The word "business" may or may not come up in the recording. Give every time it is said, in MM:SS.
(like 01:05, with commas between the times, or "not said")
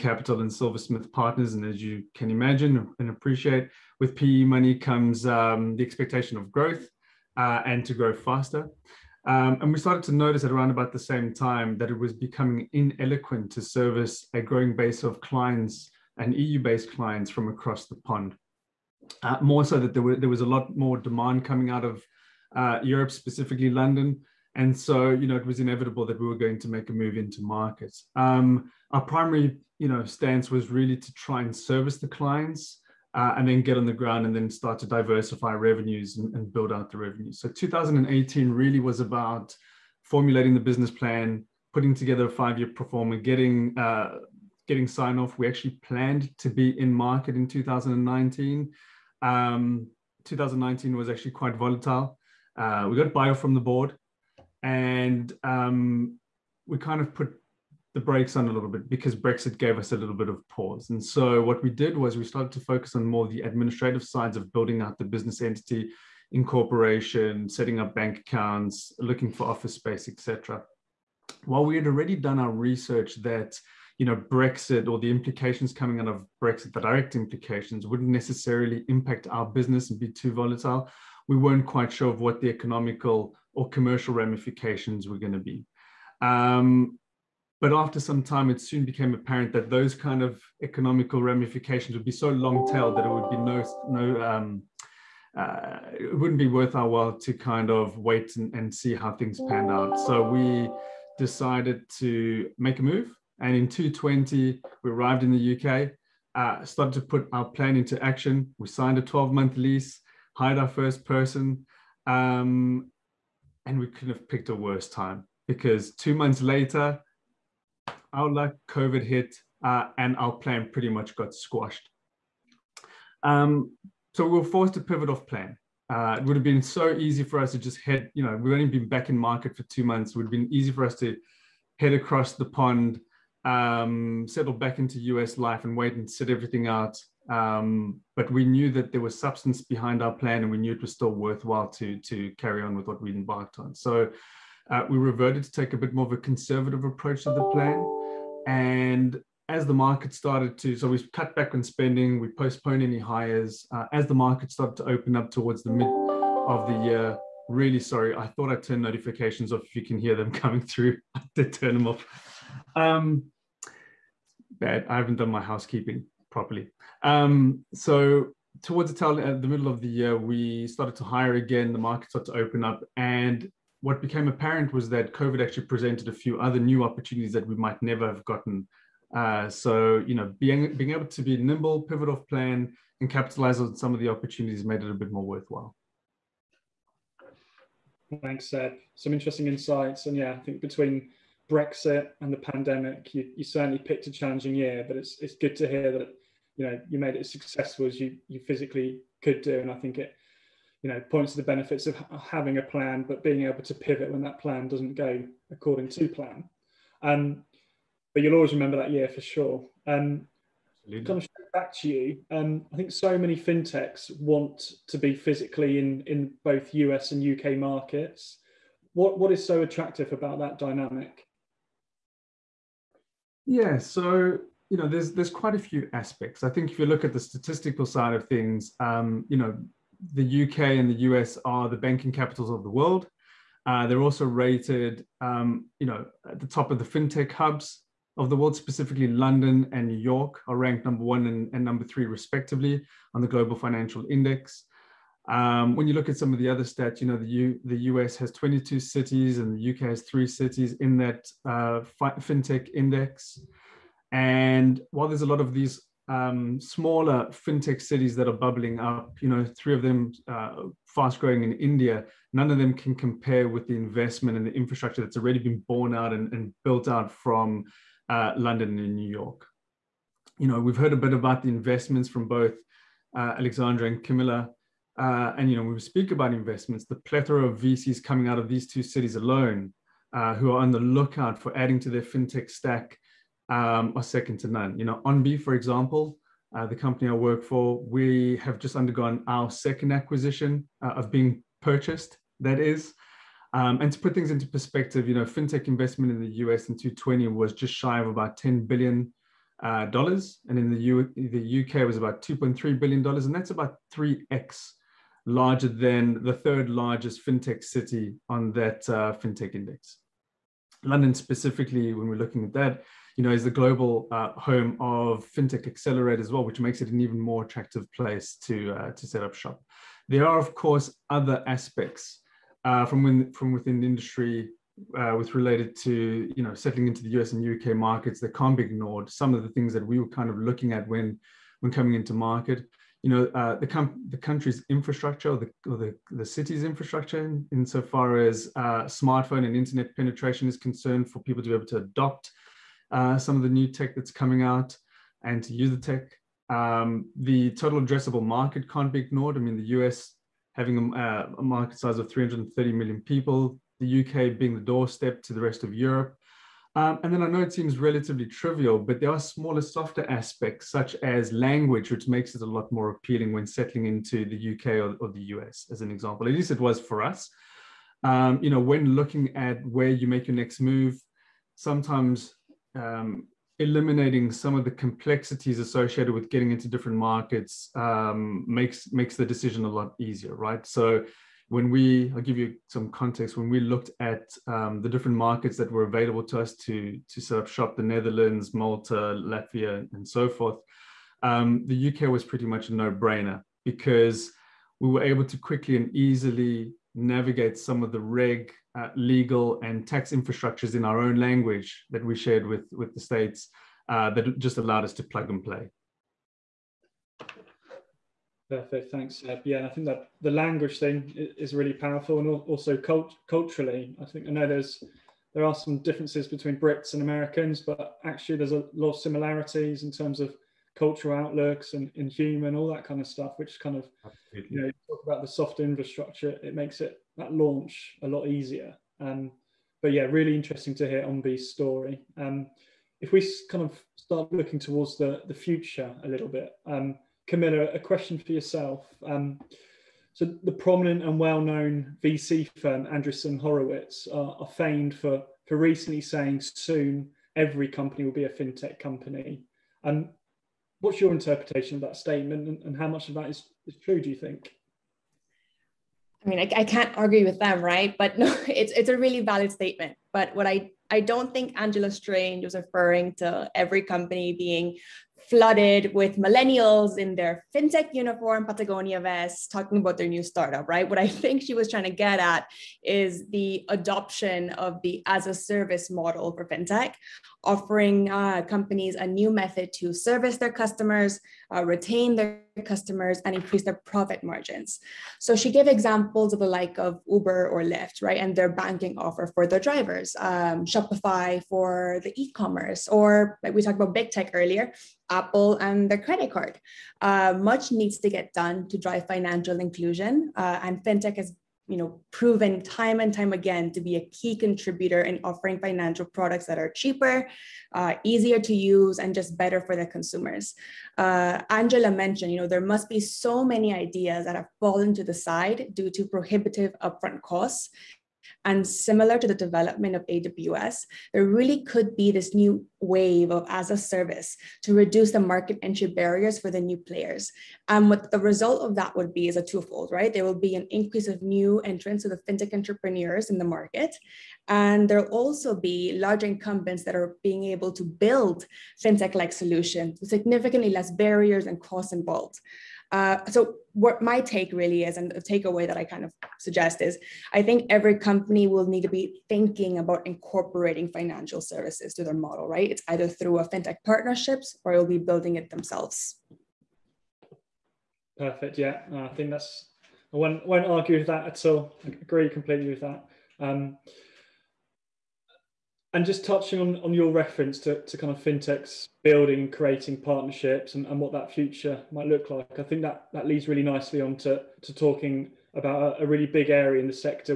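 00:40, 01:05, 01:19.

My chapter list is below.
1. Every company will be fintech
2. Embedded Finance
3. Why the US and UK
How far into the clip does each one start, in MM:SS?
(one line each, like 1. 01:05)
1. 06:47
2. 09:17
3. 03:07.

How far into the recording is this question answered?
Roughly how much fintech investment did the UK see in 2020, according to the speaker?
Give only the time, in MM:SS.
05:02.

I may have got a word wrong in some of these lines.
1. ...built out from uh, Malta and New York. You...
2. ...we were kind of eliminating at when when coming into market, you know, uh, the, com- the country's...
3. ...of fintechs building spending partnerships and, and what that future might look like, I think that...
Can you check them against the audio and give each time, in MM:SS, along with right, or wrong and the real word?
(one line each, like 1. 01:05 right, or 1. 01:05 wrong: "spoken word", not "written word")
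1. 04:26 wrong: "London", not "Malta"
2. 05:29 wrong: "looking", not "eliminating"
3. 09:28 wrong: "creating", not "spending".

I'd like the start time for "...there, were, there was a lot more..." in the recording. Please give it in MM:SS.
00:19.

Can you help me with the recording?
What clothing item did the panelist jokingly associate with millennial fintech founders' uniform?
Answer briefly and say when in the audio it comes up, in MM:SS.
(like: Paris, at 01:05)
Patagonia vest, at 07:48.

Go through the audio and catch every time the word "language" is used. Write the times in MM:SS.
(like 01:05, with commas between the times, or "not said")
06:01, 06:41, 06:50.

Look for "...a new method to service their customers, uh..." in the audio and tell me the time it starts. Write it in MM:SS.
07:58.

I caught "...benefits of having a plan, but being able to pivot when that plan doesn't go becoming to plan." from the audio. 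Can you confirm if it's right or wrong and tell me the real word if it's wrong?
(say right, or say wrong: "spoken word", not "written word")
wrong: "according", not "becoming".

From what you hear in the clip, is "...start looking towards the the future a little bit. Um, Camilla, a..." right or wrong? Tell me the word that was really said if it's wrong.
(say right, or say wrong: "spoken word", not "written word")
right.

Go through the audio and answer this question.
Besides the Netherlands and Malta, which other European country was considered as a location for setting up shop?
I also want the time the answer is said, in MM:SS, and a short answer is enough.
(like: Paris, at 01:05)
Latvia, at 06:28.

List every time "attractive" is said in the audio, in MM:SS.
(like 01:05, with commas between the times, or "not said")
03:39, 05:17.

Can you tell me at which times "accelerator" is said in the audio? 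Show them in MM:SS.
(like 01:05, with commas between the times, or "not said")
05:15.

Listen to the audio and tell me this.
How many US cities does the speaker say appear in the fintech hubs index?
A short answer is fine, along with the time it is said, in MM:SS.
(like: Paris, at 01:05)
22, at 04:08.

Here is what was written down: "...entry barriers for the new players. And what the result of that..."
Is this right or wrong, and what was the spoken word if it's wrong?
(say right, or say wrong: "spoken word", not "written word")
right.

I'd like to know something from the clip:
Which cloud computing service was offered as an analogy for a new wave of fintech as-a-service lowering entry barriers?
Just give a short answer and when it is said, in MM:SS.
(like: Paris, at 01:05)
AWS, at 08:40.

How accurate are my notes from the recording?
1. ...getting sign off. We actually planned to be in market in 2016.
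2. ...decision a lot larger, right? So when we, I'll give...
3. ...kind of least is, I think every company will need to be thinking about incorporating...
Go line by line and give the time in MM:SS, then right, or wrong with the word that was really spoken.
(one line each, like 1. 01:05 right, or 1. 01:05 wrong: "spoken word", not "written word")
1. 00:44 wrong: "2019", not "2016"
2. 06:19 wrong: "easier", not "larger"
3. 09:05 wrong: "suggest", not "least".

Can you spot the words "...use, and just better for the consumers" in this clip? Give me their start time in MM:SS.
08:28.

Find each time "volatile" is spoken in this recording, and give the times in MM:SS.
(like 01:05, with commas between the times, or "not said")
00:51, 01:20.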